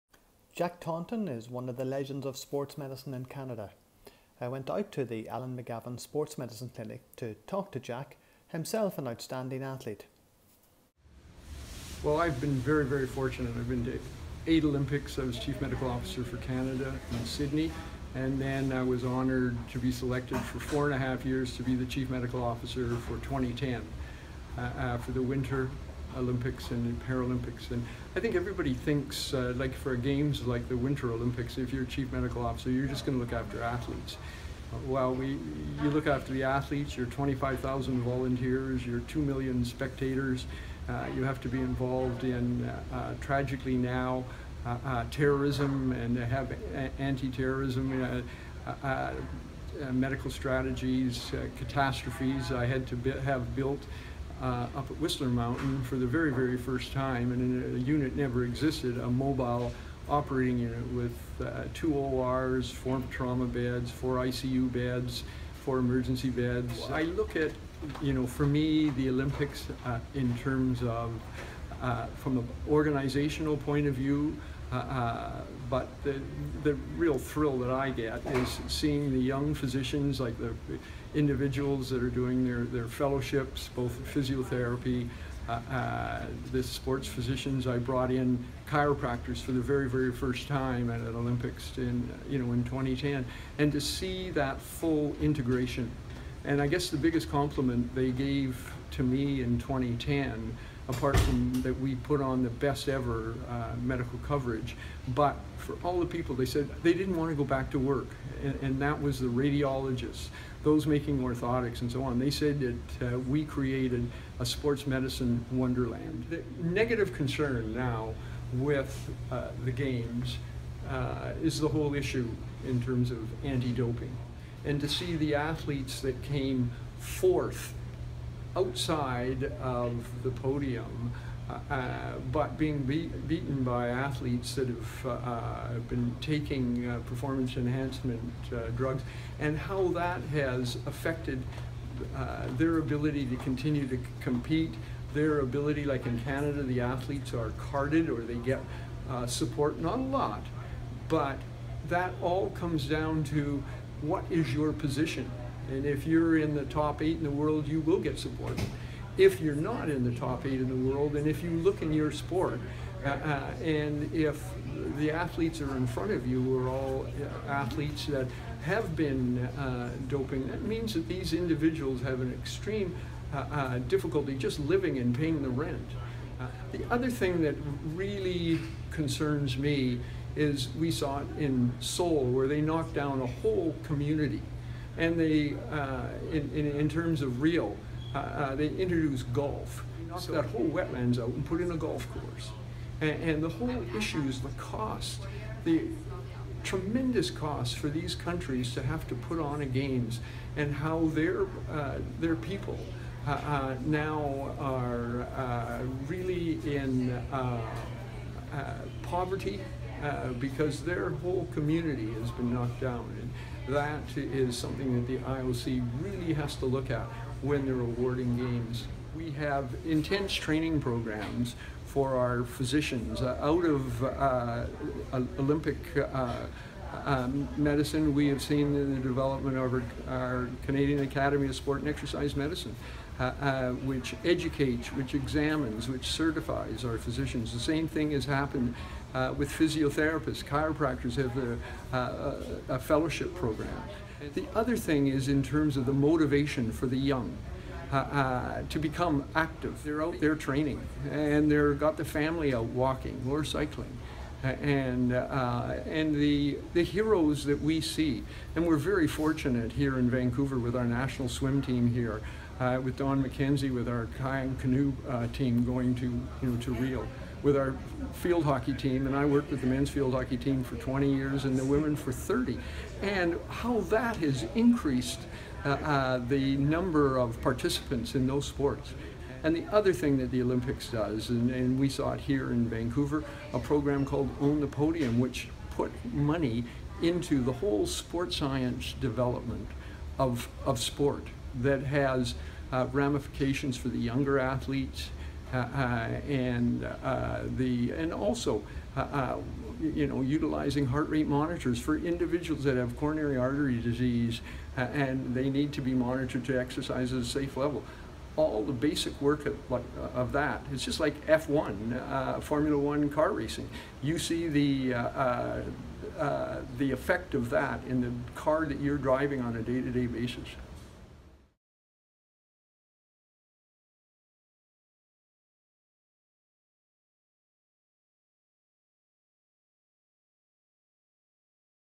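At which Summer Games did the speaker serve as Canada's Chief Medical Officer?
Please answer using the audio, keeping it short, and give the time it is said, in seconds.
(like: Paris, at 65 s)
Sydney, at 17 s.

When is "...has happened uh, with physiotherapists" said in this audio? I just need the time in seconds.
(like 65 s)
238 s.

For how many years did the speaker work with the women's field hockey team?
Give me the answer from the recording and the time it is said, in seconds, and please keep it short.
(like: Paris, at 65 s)
30, at 272 s.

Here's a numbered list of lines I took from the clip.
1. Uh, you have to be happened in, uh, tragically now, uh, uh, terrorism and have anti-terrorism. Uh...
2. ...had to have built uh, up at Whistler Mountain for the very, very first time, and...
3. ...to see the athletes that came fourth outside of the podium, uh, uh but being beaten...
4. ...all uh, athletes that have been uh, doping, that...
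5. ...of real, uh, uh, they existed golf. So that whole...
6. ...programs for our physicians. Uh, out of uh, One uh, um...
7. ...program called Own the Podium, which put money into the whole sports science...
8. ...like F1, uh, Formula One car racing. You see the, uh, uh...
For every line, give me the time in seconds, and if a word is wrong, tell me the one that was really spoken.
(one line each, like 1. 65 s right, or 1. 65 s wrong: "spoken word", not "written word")
1. 40 s wrong: "involved", not "happened"
2. 52 s right
3. 124 s right
4. 166 s right
5. 187 s wrong: "introduced", not "existed"
6. 220 s wrong: "Olympic", not "One"
7. 283 s right
8. 311 s right.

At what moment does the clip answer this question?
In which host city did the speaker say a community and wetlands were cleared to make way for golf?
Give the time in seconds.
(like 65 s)
181 s.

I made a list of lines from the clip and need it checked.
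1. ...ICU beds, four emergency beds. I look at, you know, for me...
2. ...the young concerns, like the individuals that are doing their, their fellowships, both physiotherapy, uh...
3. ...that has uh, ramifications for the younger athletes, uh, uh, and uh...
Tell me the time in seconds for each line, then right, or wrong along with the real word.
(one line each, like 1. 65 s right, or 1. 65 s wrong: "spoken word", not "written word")
1. 64 s right
2. 79 s wrong: "physicians", not "concerns"
3. 291 s right.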